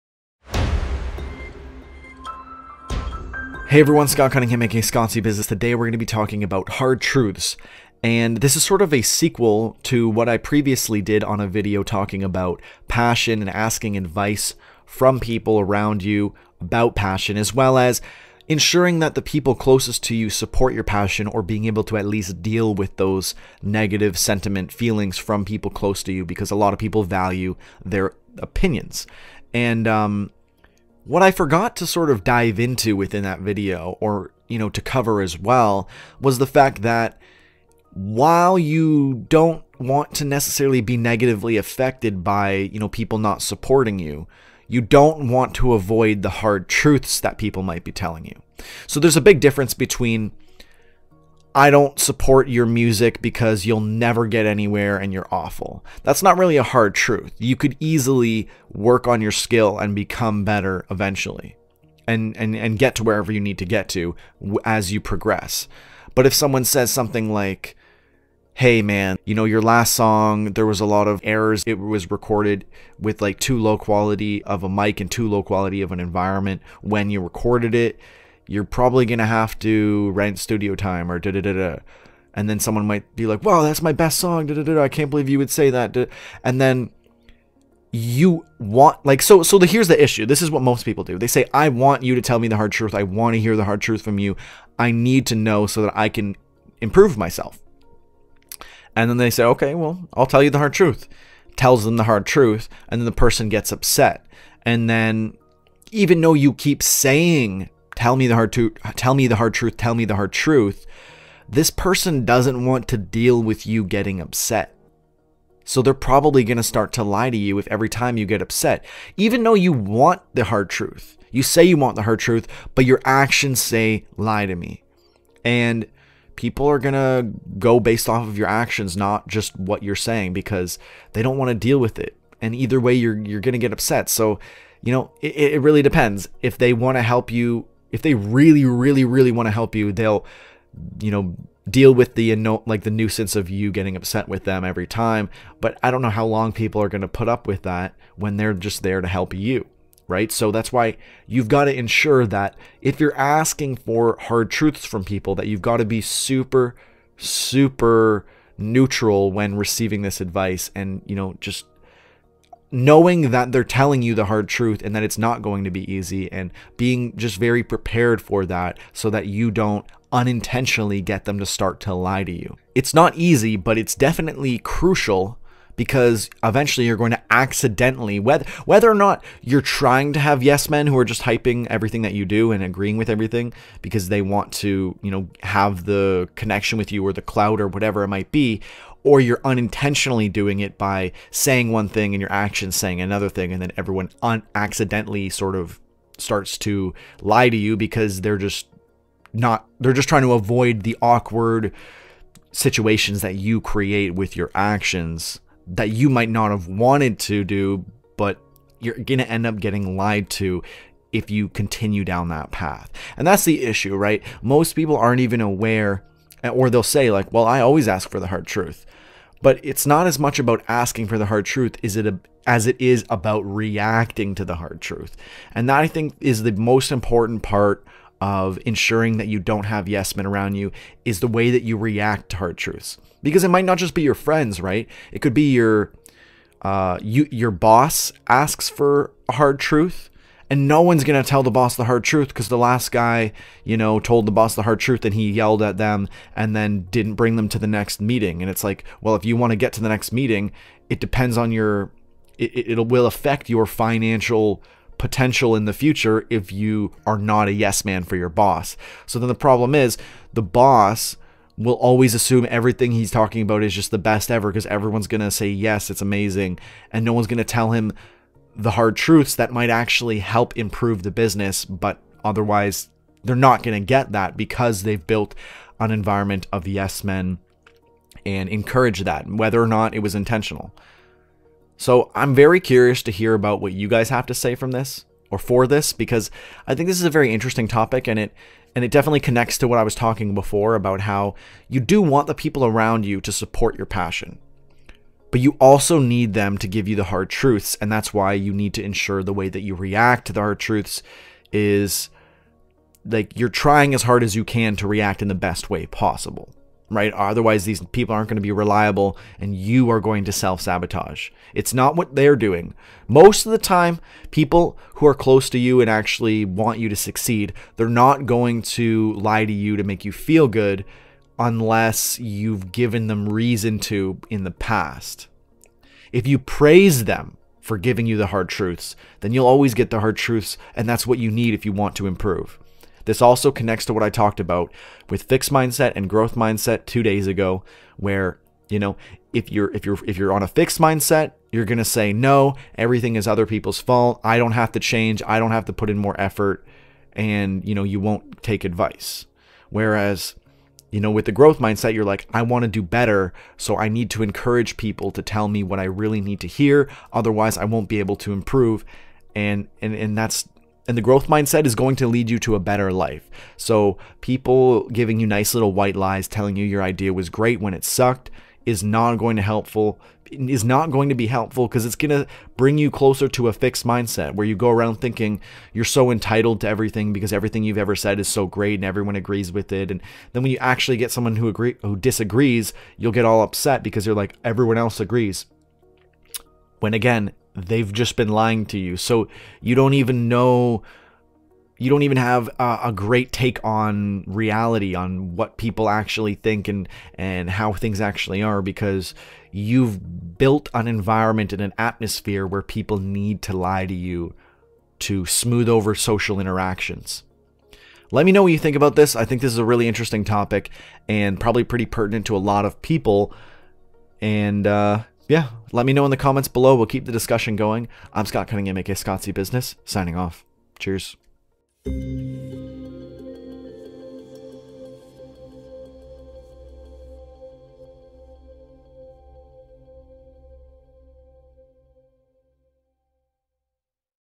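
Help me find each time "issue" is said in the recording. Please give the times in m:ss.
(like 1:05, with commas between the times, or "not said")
1:30, 3:33.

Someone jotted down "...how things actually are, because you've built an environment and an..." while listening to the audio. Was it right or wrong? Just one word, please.
right.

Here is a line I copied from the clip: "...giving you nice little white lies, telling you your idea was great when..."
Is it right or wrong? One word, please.
right.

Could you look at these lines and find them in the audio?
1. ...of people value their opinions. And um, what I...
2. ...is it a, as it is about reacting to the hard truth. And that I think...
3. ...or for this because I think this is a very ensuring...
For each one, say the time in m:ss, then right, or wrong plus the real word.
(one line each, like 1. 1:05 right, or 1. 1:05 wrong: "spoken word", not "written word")
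1. 0:26 right
2. 3:41 right
3. 4:45 wrong: "interesting", not "ensuring".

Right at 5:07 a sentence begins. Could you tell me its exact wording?
Otherwise, these people aren't going to be reliable and you are going to self sabotage.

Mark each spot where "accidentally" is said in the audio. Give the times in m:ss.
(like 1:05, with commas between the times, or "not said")
2:57, 3:14.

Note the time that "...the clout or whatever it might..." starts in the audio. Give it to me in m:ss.
3:07.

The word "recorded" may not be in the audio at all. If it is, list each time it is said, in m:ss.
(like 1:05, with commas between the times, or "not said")
1:12, 1:17.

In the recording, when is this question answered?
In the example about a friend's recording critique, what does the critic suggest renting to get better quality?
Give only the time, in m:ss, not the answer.
1:20.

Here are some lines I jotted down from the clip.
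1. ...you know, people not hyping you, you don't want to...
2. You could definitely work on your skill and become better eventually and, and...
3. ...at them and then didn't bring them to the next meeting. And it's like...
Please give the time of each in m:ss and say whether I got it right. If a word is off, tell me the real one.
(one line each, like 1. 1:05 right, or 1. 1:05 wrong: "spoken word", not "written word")
1. 0:42 wrong: "supporting", not "hyping"
2. 0:57 wrong: "easily", not "definitely"
3. 4:05 right.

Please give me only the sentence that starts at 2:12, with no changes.
And either way you're you're going to get upset.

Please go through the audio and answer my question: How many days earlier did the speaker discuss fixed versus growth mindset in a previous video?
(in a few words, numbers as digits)
2.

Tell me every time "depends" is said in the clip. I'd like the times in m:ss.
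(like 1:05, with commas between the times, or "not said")
2:15, 4:10.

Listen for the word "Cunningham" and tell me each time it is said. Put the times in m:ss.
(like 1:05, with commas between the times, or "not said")
0:04, 6:58.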